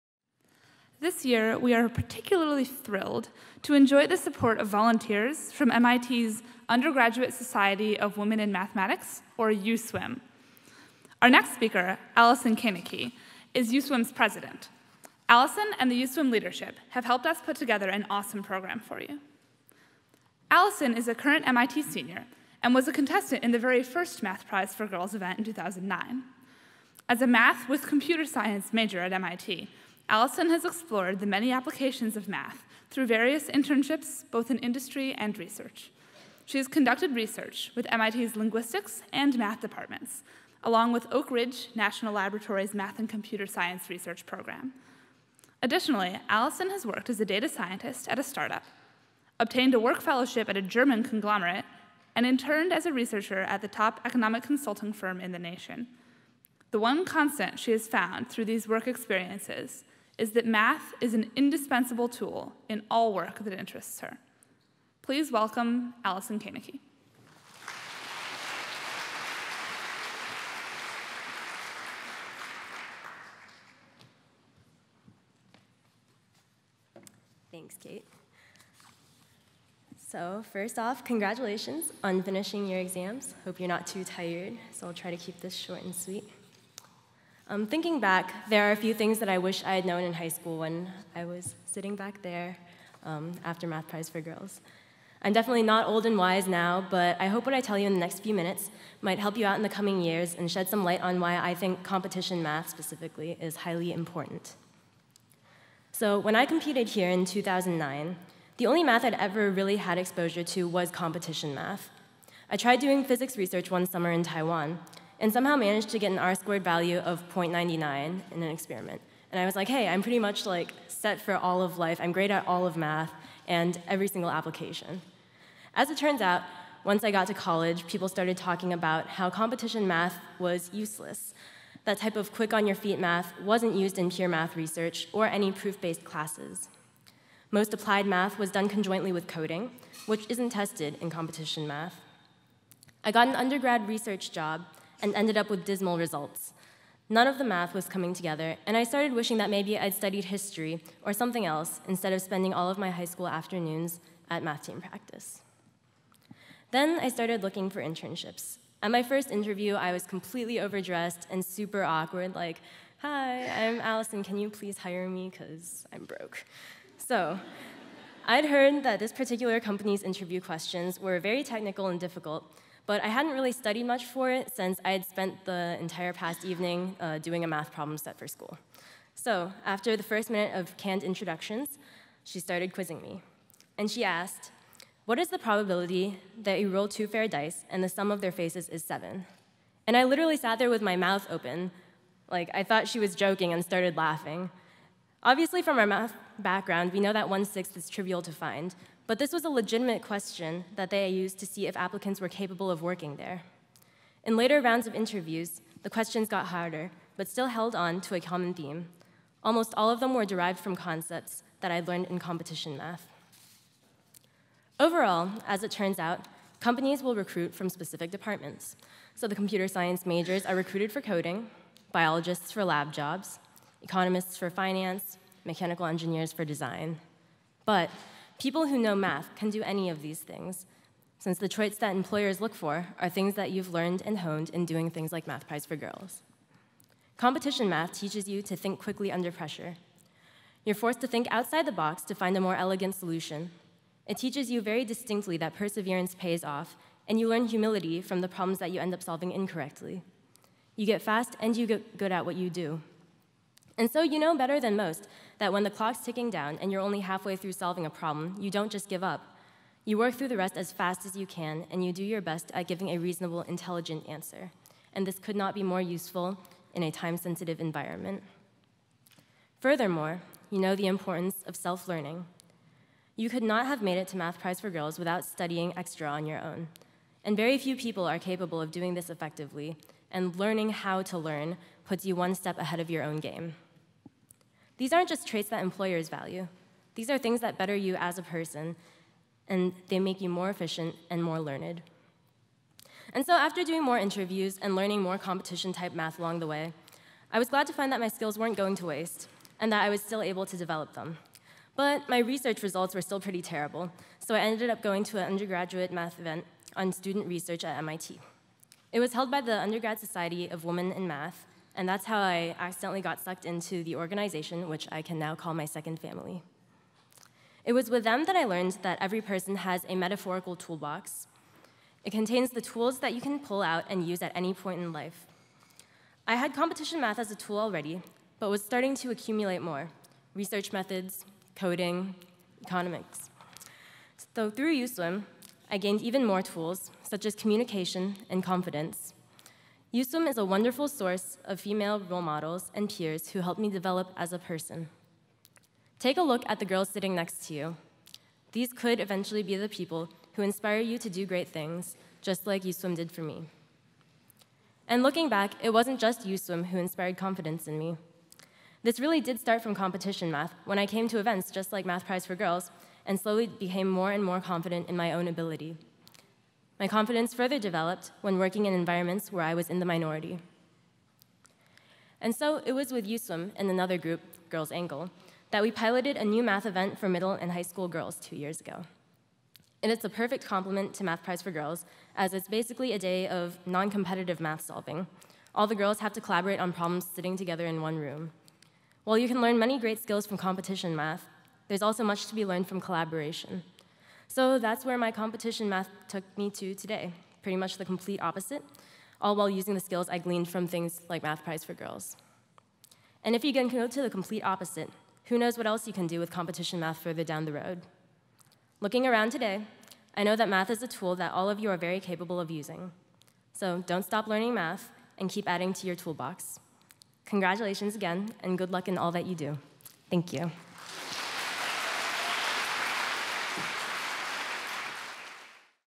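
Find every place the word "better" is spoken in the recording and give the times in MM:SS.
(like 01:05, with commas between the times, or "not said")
04:14, 04:47.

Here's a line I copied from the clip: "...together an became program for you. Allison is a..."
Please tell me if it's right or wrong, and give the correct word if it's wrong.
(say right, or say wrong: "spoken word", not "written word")
wrong: "awesome", not "became".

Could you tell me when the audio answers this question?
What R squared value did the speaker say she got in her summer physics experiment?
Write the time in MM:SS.
01:57.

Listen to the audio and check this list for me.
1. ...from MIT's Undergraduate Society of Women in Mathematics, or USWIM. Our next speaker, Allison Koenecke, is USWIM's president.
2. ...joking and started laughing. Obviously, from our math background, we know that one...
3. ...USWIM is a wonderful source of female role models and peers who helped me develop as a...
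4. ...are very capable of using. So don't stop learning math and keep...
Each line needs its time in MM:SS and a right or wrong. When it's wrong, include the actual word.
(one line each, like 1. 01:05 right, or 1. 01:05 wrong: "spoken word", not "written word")
1. 00:05 right
2. 03:13 right
3. 05:39 right
4. 06:51 right.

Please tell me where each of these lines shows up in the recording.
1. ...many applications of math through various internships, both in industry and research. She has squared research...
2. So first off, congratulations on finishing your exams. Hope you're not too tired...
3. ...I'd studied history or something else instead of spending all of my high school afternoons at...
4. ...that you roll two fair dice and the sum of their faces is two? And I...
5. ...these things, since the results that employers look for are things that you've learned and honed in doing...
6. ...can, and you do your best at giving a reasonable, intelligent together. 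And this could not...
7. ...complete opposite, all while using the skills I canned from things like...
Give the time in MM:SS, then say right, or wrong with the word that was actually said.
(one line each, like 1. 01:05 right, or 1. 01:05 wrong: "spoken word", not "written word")
1. 00:31 wrong: "conducted", not "squared"
2. 01:20 right
3. 02:29 right
4. 03:06 wrong: "seven", not "two"
5. 03:50 wrong: "traits", not "results"
6. 04:21 wrong: "answer", not "together"
7. 06:37 wrong: "gleaned", not "canned".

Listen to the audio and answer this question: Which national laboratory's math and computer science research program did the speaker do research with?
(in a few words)
Oak Ridge National Laboratory.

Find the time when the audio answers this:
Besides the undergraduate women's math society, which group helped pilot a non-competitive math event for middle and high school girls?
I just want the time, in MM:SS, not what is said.
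06:14.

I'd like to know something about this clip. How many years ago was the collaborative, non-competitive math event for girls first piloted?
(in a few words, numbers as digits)
2.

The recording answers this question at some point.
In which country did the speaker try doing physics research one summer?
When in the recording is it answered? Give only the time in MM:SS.
01:54.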